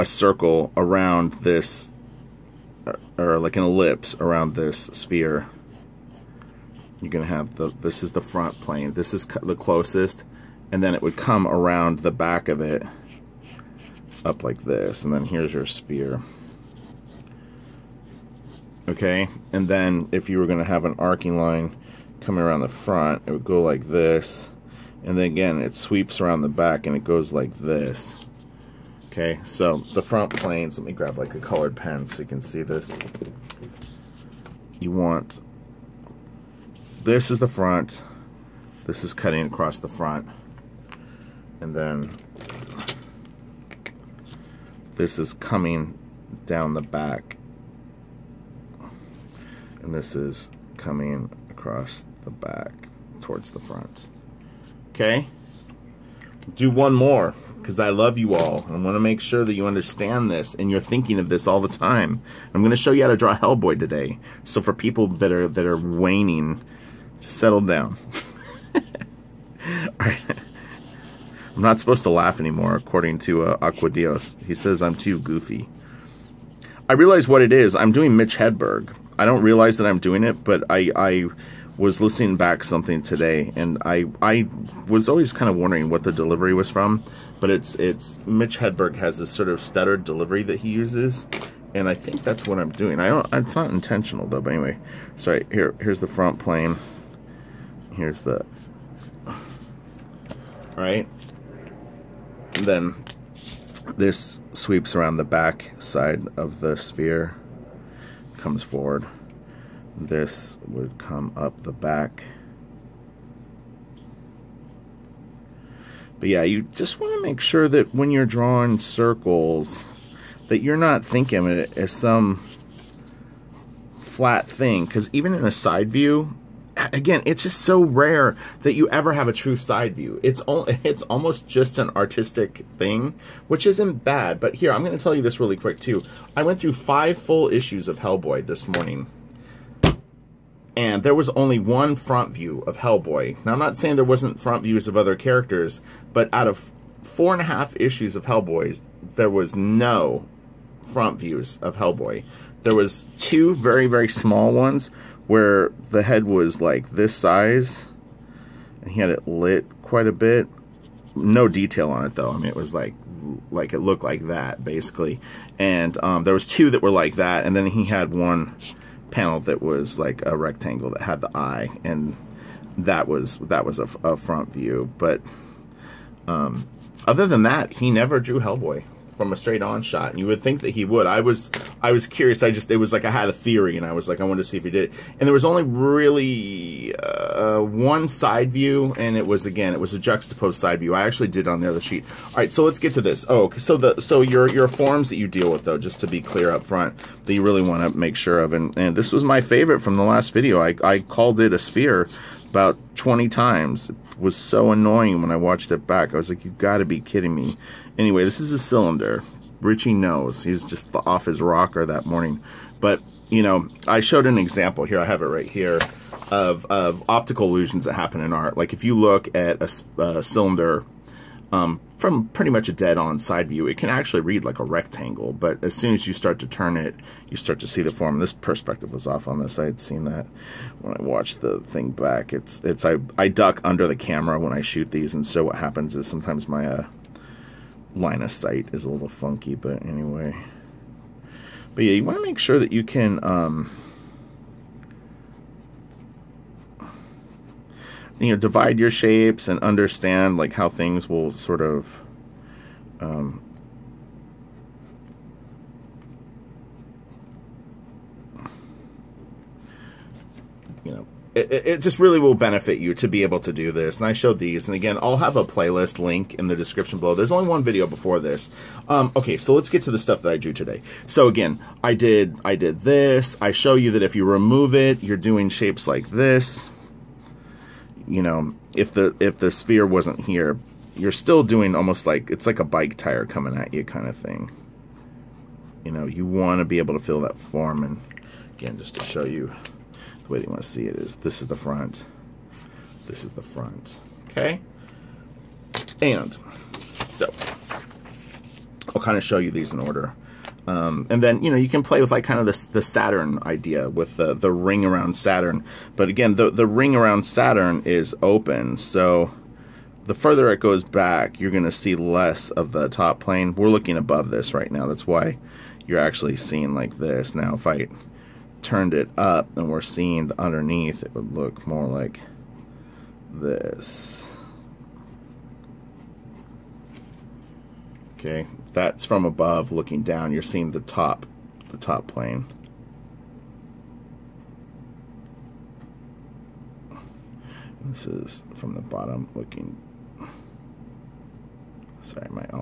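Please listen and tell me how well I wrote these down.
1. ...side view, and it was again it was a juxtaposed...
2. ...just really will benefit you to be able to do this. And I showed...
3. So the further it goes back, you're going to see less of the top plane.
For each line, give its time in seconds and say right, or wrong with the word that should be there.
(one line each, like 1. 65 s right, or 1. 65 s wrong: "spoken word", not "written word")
1. 188 s right
2. 261 s right
3. 308 s right.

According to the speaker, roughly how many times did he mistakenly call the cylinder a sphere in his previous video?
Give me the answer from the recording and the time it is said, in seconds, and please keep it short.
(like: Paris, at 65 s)
20, at 202 s.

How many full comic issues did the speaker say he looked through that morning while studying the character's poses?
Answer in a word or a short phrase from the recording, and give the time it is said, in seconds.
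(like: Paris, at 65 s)
5, at 136 s.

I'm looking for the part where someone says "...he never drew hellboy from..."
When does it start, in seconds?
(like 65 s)
177 s.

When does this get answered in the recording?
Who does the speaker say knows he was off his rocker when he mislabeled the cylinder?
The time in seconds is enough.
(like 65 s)
209 s.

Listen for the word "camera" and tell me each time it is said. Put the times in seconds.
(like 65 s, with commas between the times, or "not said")
233 s.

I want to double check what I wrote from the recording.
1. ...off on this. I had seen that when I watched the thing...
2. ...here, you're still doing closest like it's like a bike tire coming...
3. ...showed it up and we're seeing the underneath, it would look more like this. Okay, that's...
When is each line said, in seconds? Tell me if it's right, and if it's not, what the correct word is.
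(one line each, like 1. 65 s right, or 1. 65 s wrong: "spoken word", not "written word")
1. 229 s right
2. 280 s wrong: "almost", not "closest"
3. 318 s wrong: "turned", not "showed".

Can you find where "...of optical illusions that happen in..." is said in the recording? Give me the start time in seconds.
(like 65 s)
216 s.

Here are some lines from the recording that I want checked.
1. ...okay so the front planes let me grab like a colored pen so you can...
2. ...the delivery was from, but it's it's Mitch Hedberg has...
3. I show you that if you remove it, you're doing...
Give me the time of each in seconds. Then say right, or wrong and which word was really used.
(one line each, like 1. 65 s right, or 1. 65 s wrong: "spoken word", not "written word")
1. 29 s right
2. 86 s right
3. 273 s right.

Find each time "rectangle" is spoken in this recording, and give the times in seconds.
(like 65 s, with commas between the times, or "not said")
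170 s, 224 s.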